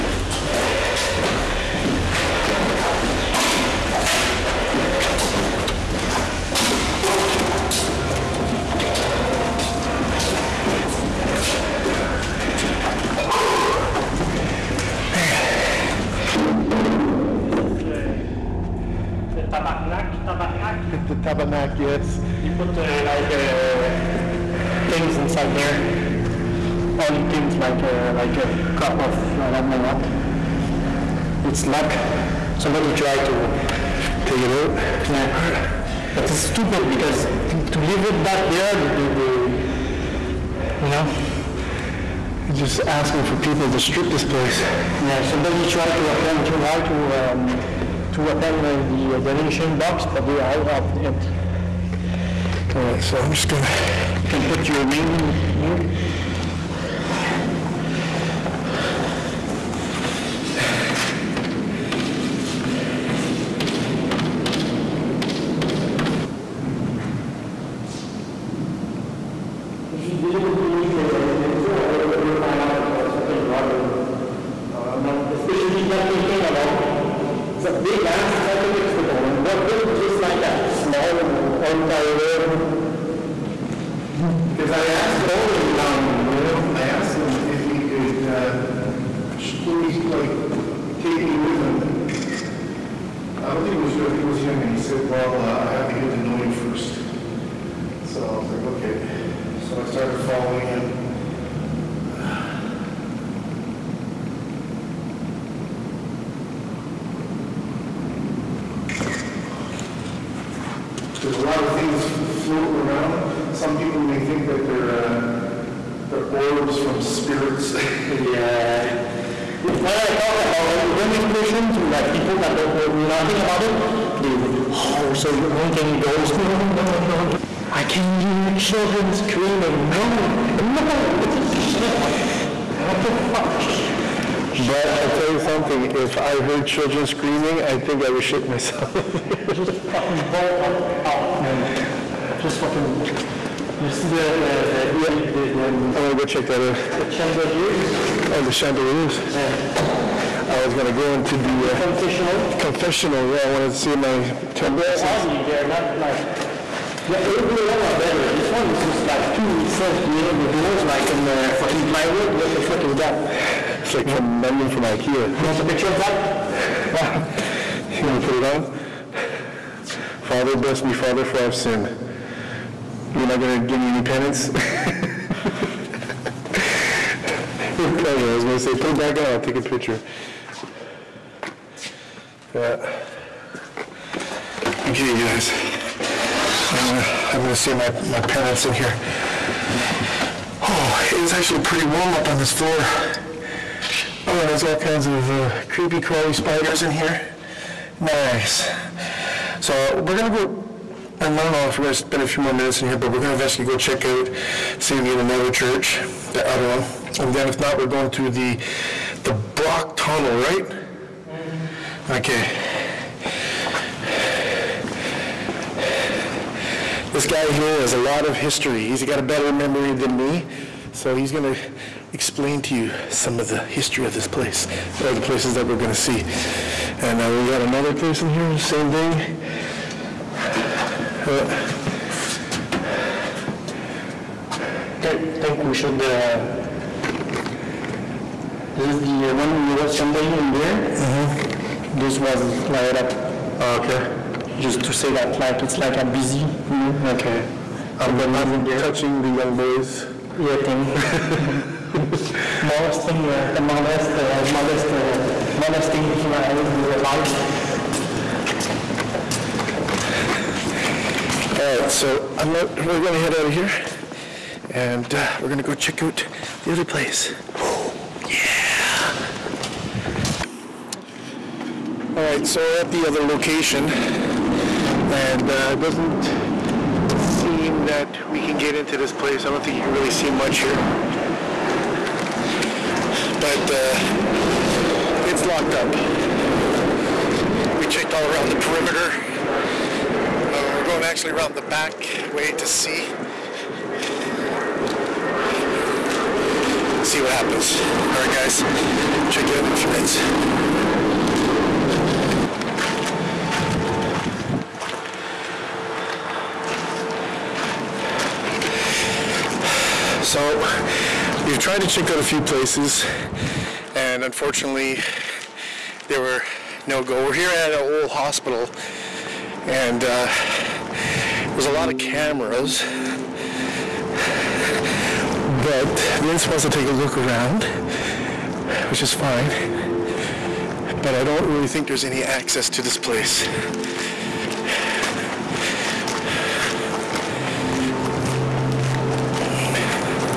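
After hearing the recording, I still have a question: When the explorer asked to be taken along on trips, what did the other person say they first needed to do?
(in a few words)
get to know you first.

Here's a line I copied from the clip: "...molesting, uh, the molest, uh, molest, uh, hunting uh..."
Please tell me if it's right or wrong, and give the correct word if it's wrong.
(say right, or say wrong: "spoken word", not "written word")
wrong: "molesting", not "hunting".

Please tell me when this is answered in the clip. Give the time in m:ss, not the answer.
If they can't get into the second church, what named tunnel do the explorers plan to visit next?
3:29.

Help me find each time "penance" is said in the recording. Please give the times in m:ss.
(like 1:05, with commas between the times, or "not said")
2:54, 3:08.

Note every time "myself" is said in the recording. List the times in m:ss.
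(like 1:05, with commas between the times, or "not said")
2:18.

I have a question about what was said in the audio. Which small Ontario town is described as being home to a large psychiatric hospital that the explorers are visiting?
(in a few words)
Brockville.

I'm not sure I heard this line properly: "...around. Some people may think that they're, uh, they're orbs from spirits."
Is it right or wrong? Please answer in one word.
right.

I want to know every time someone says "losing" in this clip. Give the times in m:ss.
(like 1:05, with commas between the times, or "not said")
not said.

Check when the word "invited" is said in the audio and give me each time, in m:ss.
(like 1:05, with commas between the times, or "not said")
not said.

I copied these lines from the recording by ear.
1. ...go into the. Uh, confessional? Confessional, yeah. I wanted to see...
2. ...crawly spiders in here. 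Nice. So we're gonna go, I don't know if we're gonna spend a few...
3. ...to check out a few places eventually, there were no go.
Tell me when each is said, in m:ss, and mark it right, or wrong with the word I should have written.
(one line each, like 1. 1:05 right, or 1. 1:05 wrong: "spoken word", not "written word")
1. 2:30 right
2. 3:15 right
3. 5:11 wrong: "unfortunately", not "eventually".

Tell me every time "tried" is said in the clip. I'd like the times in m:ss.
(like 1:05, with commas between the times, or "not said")
0:32, 0:45, 5:11.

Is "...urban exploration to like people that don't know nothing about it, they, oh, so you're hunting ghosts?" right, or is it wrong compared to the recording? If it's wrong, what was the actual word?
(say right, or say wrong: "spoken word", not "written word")
right.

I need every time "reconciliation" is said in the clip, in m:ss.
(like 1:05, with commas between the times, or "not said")
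not said.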